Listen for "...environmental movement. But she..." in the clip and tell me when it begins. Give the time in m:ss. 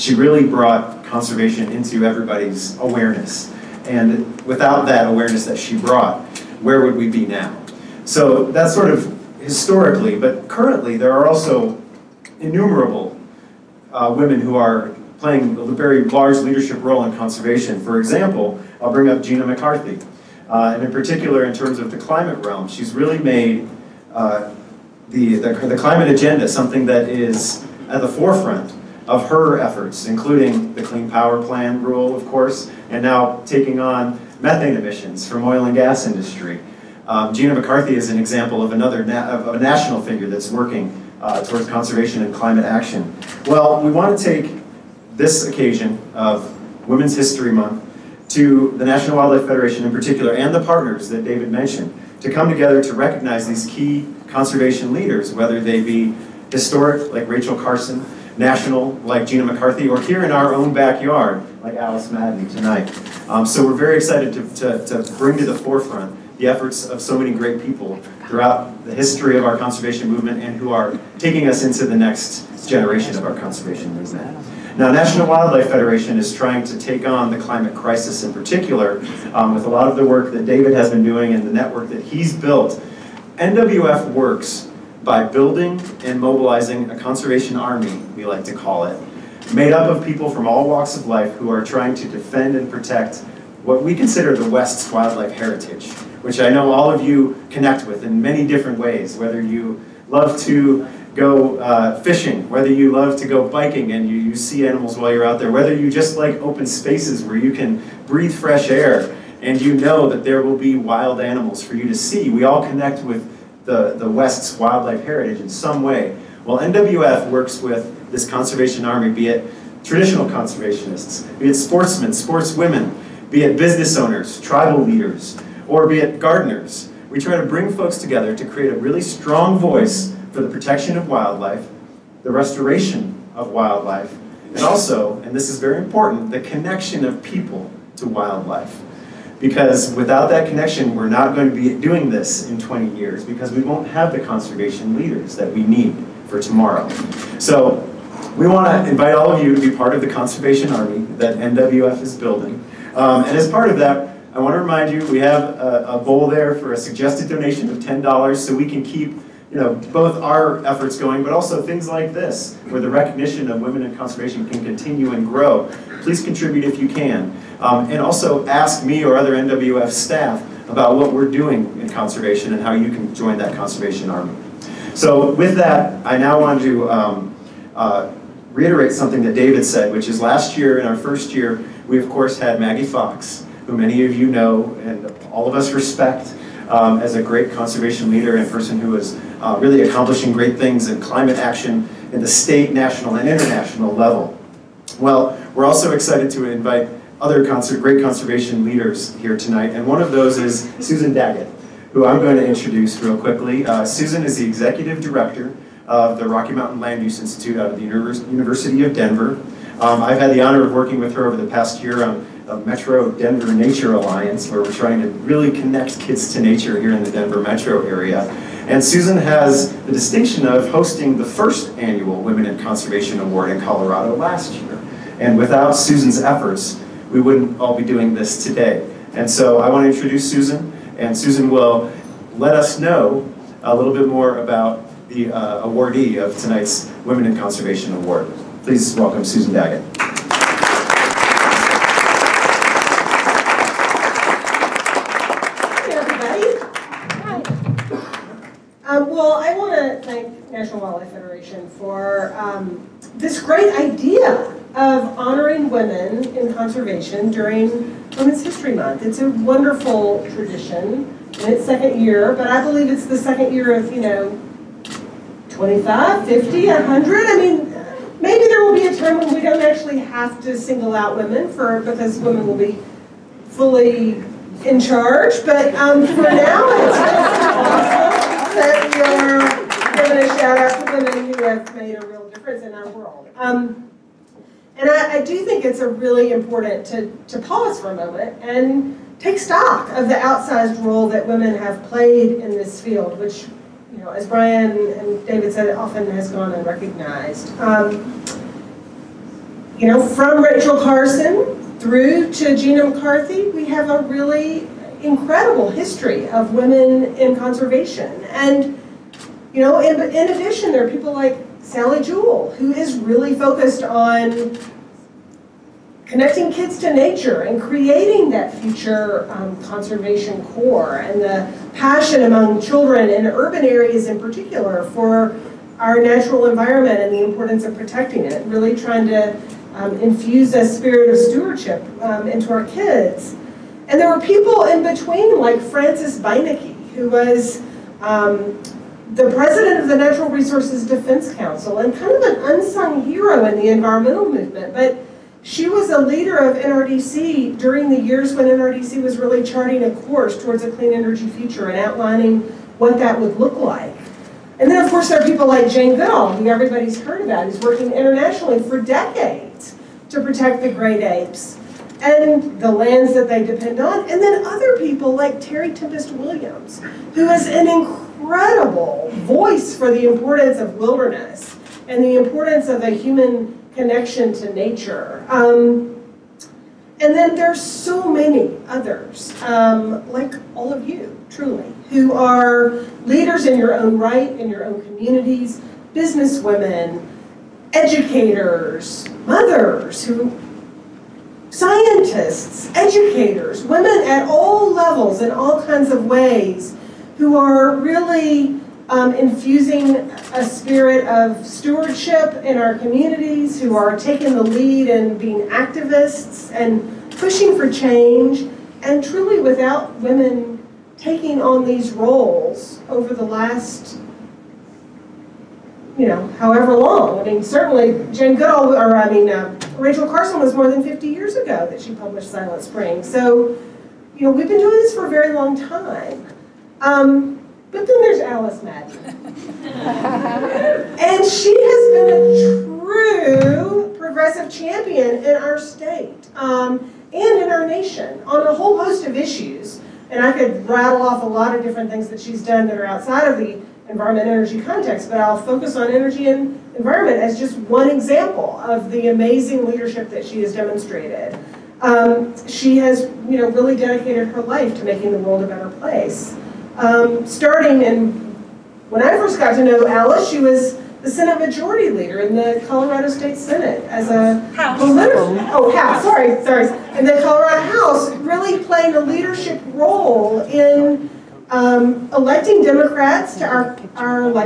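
5:43.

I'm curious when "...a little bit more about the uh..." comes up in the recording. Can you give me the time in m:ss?
3:53.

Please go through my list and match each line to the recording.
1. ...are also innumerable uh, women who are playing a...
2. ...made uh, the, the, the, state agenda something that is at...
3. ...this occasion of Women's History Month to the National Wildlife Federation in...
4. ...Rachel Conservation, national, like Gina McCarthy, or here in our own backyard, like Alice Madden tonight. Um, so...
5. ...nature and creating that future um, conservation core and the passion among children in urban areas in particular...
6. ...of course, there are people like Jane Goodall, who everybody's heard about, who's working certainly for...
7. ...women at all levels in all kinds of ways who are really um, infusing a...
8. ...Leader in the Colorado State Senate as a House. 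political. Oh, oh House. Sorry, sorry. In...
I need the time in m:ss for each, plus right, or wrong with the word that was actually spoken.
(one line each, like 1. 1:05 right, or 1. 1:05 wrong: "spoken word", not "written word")
1. 0:11 right
2. 0:23 wrong: "climate", not "state"
3. 0:45 right
4. 0:57 wrong: "Carson", not "Conservation"
5. 5:16 right
6. 5:54 wrong: "internationally", not "certainly"
7. 6:33 right
8. 7:41 right.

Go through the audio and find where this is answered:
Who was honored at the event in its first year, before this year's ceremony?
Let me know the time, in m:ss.
3:02.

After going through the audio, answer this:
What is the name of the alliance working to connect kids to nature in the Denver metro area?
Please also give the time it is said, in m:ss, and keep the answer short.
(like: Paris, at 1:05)
Metro Denver Nature Alliance, at 3:32.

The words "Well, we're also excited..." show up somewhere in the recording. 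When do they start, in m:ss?
3:14.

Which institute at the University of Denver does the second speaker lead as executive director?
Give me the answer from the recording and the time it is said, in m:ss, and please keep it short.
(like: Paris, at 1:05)
Rocky Mountain Land Use Institute, at 3:26.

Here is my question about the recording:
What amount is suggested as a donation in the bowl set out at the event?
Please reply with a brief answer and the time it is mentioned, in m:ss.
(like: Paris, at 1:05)
$10, at 2:37.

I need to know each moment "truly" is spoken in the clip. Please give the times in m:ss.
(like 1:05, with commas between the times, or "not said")
6:21, 6:49.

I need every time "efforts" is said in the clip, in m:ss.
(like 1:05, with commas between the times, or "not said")
0:29, 1:06, 2:40, 3:46.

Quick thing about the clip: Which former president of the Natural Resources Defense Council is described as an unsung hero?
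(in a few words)
Frances Beinecke.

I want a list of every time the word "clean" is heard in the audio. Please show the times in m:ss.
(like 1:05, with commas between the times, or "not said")
0:30, 5:50.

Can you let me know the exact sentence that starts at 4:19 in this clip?
It's a wonderful tradition in its second year, but I believe it's the second year of, you know, 25, 50, 100.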